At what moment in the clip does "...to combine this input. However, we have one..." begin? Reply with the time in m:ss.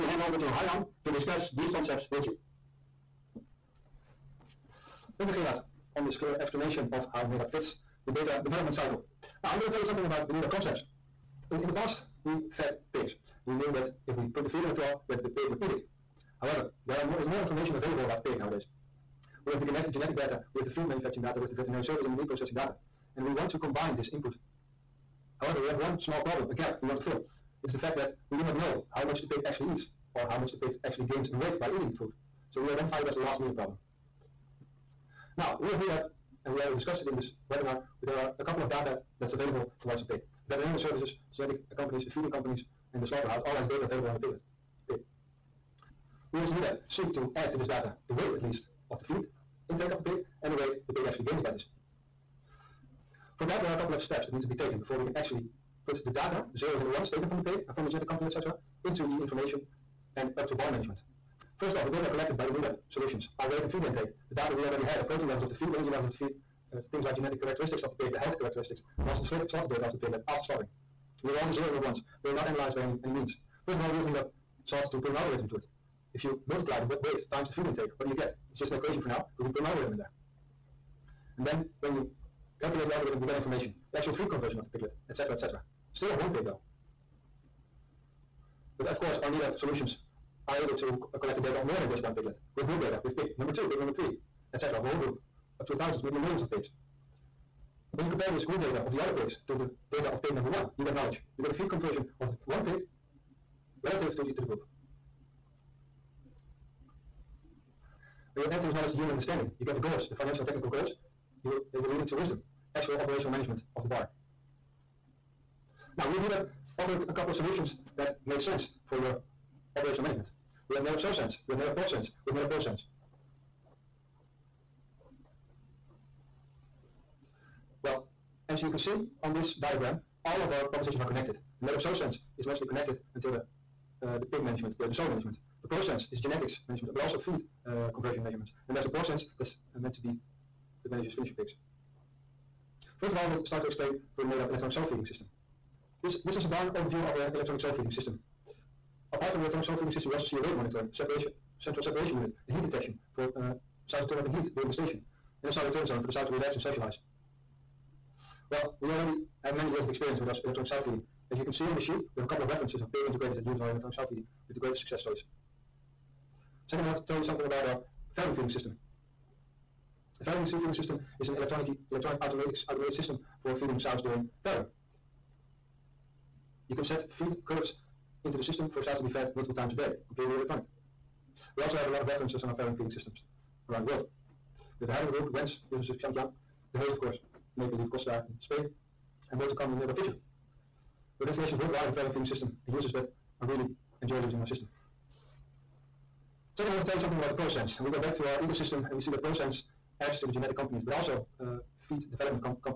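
0:23.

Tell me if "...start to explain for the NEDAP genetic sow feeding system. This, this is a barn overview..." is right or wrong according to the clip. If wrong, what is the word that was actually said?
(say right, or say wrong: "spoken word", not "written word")
wrong: "electronic", not "genetic".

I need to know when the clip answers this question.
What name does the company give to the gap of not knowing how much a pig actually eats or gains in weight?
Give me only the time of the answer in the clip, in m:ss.
0:33.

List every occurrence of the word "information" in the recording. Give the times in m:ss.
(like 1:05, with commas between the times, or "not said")
0:17, 0:59, 1:23.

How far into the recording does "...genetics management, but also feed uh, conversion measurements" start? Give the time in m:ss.
2:16.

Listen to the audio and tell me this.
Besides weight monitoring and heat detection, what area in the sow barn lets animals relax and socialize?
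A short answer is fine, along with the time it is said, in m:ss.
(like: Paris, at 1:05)
sow return zone, at 2:35.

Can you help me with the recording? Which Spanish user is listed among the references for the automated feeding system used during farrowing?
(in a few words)
Costa.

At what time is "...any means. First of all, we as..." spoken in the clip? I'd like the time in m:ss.
1:13.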